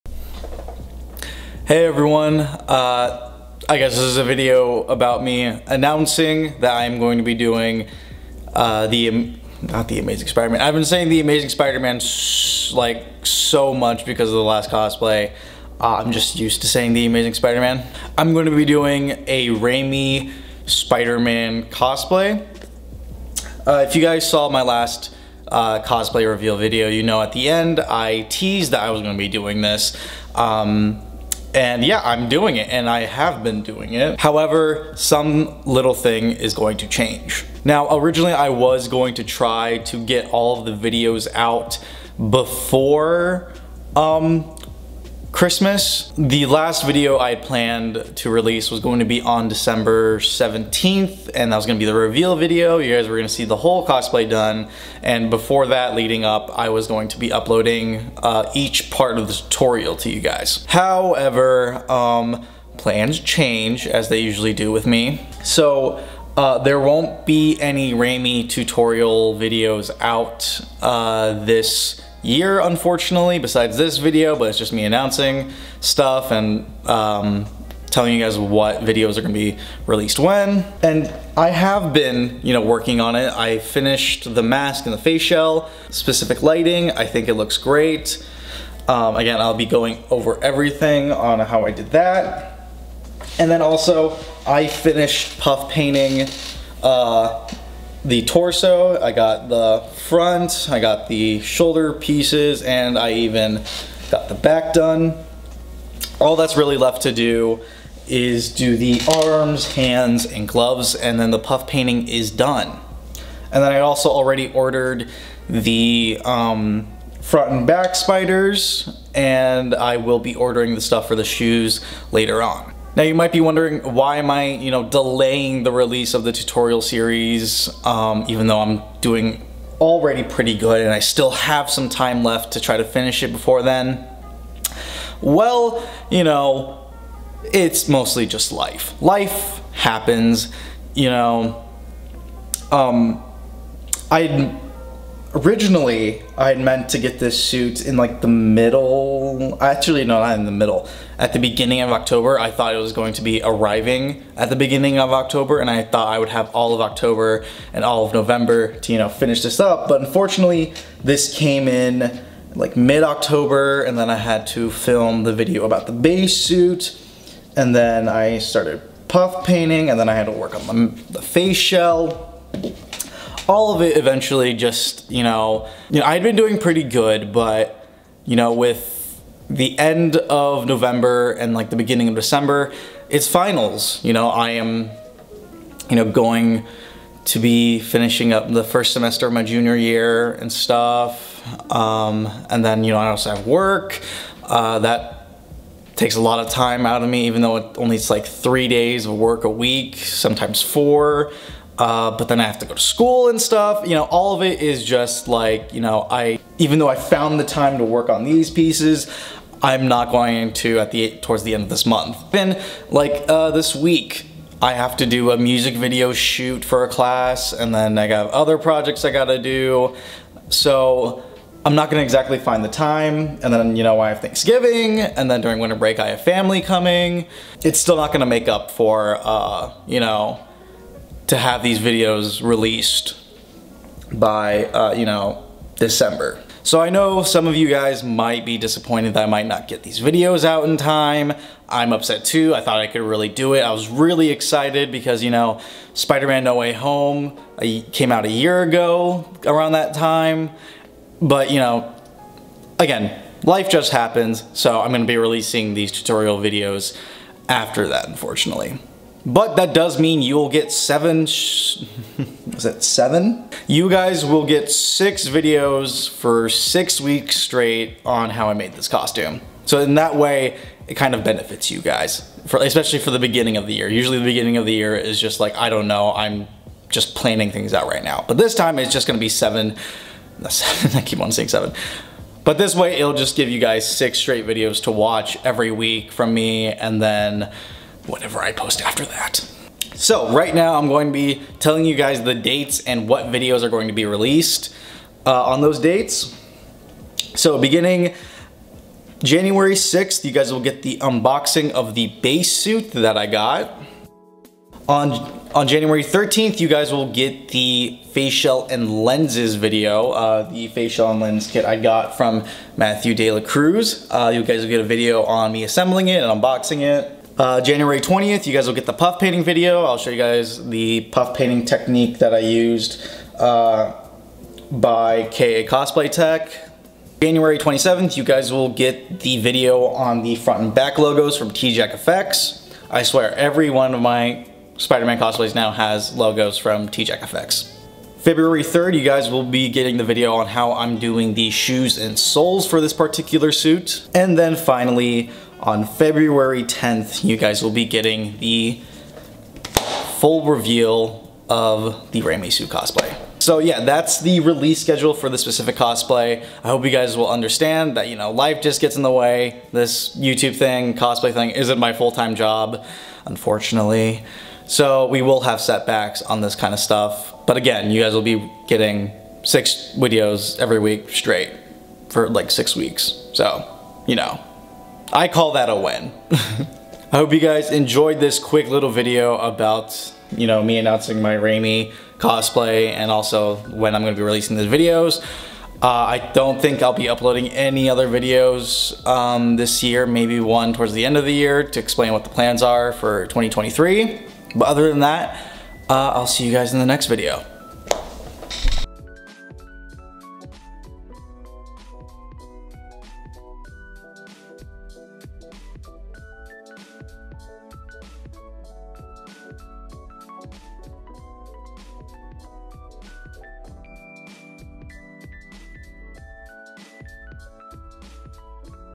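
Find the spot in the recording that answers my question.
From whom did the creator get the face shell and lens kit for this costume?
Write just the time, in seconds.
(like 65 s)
312 s.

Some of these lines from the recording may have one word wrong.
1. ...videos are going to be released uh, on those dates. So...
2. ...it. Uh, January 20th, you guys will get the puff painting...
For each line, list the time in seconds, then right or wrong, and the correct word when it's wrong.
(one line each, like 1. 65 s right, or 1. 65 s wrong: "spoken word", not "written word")
1. 293 s right
2. 316 s right.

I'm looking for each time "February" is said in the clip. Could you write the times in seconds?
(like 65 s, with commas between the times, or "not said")
338 s, 345 s.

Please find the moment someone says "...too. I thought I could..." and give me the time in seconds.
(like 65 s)
242 s.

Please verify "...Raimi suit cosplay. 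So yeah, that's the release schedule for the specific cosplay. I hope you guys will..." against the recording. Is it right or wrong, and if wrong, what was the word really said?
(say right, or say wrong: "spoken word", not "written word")
right.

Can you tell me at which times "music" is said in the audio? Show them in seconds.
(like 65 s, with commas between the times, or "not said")
215 s.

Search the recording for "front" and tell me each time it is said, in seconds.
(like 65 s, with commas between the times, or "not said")
100 s, 117 s, 330 s.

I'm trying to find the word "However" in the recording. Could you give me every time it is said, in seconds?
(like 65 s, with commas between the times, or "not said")
34 s, 60 s.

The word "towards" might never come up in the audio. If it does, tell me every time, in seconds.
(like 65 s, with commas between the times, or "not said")
211 s, 390 s.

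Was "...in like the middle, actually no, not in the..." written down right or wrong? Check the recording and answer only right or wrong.
right.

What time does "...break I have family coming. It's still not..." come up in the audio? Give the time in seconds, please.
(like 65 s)
225 s.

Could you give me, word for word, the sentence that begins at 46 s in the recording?
The last video I planned to release was going to be on December 17th and that was gonna be the reveal video.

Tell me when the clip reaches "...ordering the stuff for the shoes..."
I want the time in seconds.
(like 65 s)
120 s.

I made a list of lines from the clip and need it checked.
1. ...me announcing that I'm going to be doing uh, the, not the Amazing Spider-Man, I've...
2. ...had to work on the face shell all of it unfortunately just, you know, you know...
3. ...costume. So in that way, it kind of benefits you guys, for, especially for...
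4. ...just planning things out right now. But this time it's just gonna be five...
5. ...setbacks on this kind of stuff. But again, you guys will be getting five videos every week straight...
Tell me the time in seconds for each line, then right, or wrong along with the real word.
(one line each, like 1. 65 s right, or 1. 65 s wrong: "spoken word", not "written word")
1. 5 s right
2. 170 s wrong: "eventually", not "unfortunately"
3. 268 s right
4. 276 s wrong: "seven", not "five"
5. 365 s wrong: "six", not "five".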